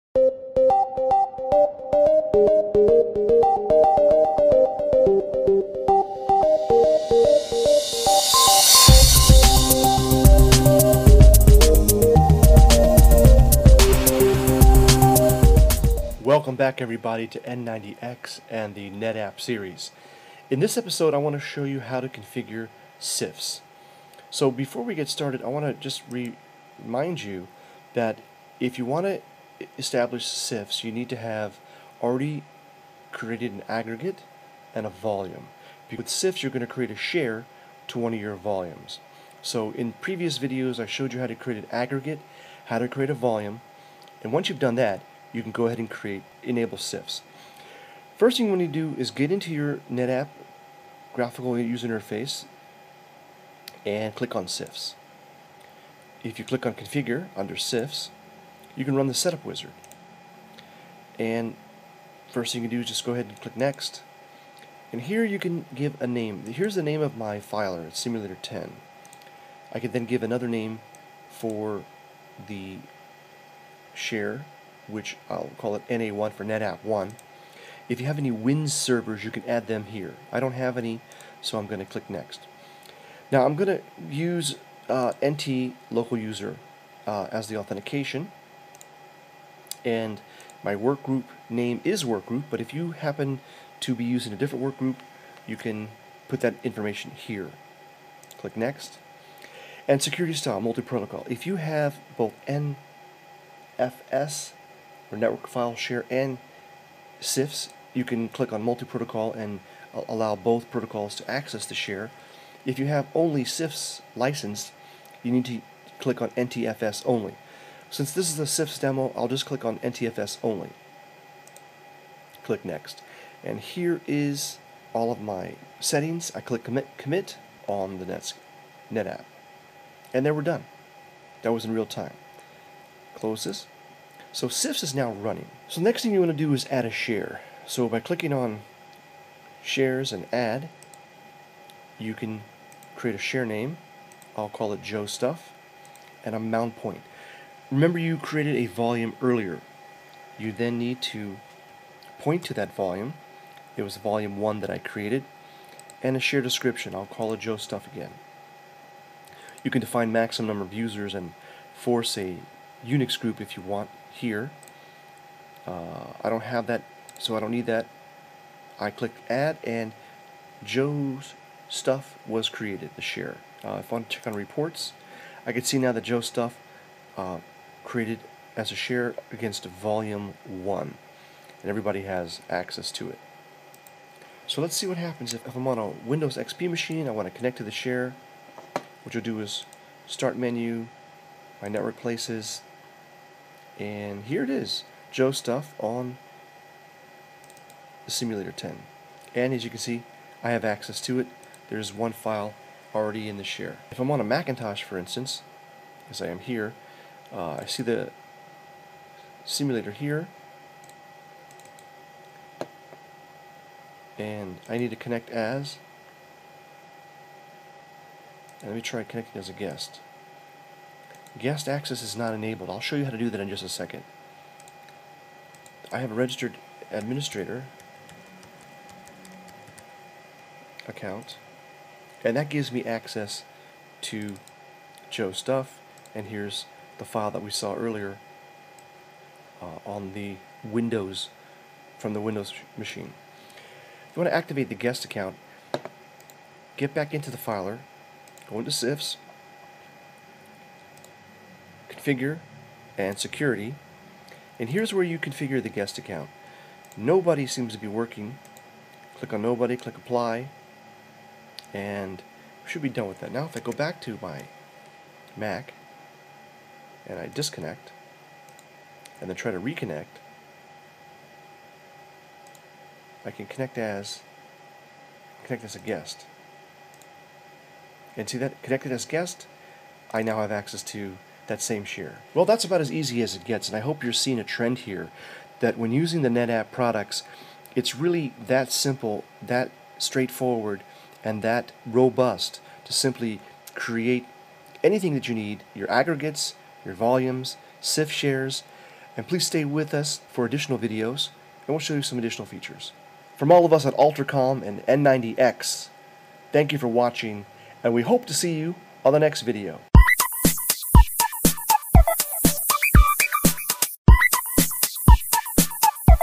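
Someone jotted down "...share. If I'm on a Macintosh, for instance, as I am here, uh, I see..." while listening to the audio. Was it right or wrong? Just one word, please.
right.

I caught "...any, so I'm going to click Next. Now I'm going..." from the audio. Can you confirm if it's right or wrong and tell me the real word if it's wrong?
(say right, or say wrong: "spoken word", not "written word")
right.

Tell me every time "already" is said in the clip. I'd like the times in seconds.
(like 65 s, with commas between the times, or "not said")
32 s, 202 s.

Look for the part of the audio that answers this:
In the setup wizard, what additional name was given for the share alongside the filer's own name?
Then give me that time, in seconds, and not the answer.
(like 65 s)
75 s.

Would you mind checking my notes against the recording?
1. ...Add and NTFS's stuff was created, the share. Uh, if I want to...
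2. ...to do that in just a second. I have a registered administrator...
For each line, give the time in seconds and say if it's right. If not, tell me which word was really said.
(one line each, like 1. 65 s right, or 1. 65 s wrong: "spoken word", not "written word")
1. 169 s wrong: "Joe", not "NTFS"
2. 223 s right.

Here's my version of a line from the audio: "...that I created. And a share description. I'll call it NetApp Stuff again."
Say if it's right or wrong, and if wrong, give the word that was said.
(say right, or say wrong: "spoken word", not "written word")
wrong: "Joe", not "NetApp".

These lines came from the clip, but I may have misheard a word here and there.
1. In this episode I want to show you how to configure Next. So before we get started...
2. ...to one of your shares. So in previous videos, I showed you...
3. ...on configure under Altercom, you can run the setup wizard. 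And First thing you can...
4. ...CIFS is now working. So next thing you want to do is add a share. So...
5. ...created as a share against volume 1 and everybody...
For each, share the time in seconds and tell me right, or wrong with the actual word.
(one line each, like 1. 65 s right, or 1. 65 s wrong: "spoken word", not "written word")
1. 20 s wrong: "CIFS", not "Next"
2. 37 s wrong: "volumes", not "shares"
3. 56 s wrong: "CIFS", not "Altercom"
4. 134 s wrong: "running", not "working"
5. 177 s right.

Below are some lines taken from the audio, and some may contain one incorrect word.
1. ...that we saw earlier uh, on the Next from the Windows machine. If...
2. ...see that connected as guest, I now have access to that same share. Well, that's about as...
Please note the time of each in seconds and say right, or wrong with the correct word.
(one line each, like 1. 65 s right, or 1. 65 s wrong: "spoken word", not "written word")
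1. 237 s wrong: "Windows", not "Next"
2. 278 s right.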